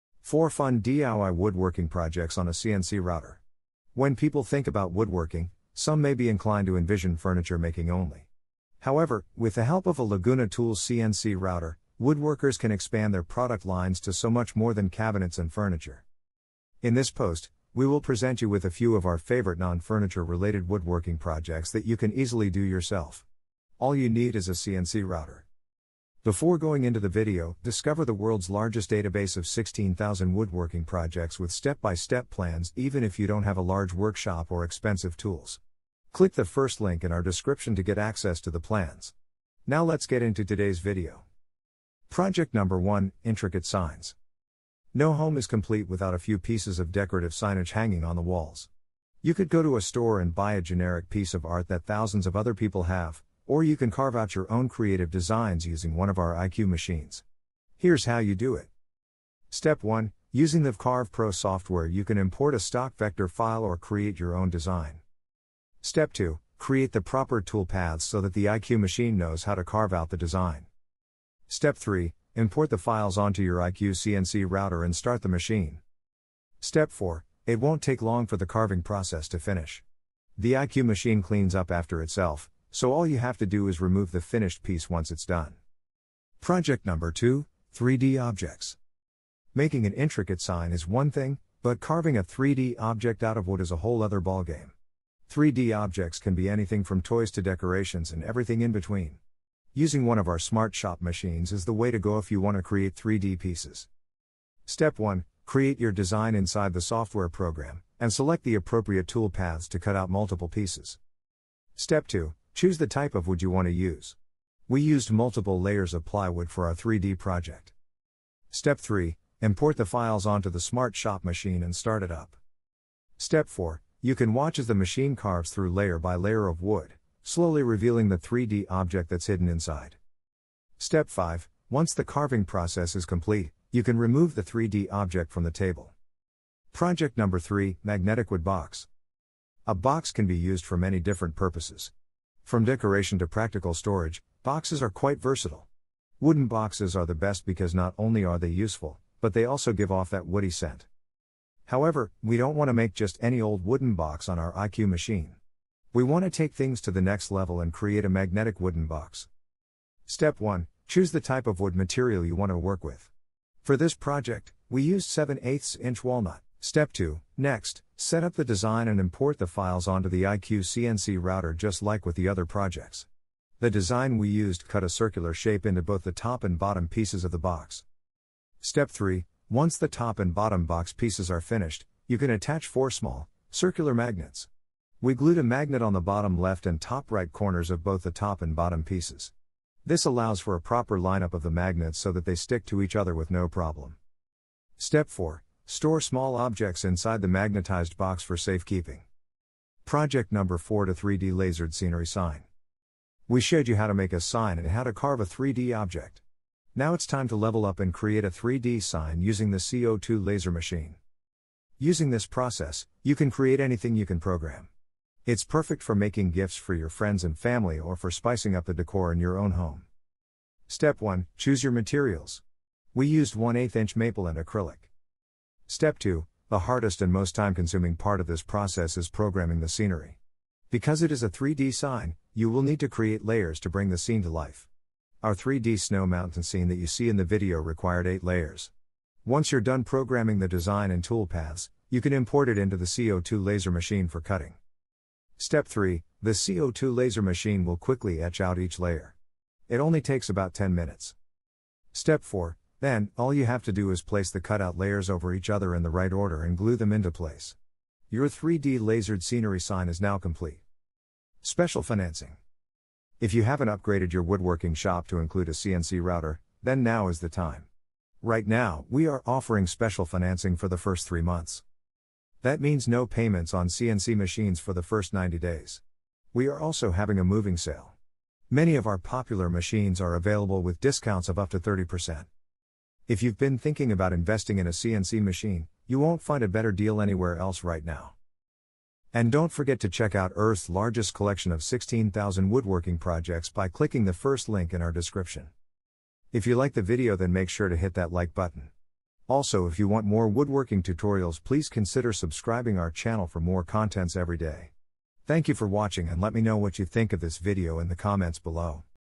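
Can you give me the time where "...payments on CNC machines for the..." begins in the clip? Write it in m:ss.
4:33.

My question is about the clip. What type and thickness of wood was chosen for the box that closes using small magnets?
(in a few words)
7/8 inch walnut.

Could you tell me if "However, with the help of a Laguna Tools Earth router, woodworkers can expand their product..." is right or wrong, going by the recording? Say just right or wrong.
wrong.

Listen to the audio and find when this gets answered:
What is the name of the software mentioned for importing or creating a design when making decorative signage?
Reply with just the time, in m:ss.
1:00.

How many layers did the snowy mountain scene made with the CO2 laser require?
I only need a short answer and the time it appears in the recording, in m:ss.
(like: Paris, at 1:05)
8, at 3:58.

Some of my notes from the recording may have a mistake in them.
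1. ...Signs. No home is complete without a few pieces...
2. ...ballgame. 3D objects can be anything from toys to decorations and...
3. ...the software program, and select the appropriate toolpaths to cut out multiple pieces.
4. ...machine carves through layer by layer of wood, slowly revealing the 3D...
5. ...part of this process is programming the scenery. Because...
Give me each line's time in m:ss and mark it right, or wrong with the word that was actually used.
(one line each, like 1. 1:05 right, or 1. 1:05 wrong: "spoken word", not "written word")
1. 0:43 right
2. 1:34 right
3. 1:46 right
4. 2:04 right
5. 3:47 right.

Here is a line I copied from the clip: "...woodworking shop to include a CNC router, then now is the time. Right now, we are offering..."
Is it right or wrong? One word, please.
right.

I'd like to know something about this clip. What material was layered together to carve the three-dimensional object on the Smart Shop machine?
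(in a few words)
plywood.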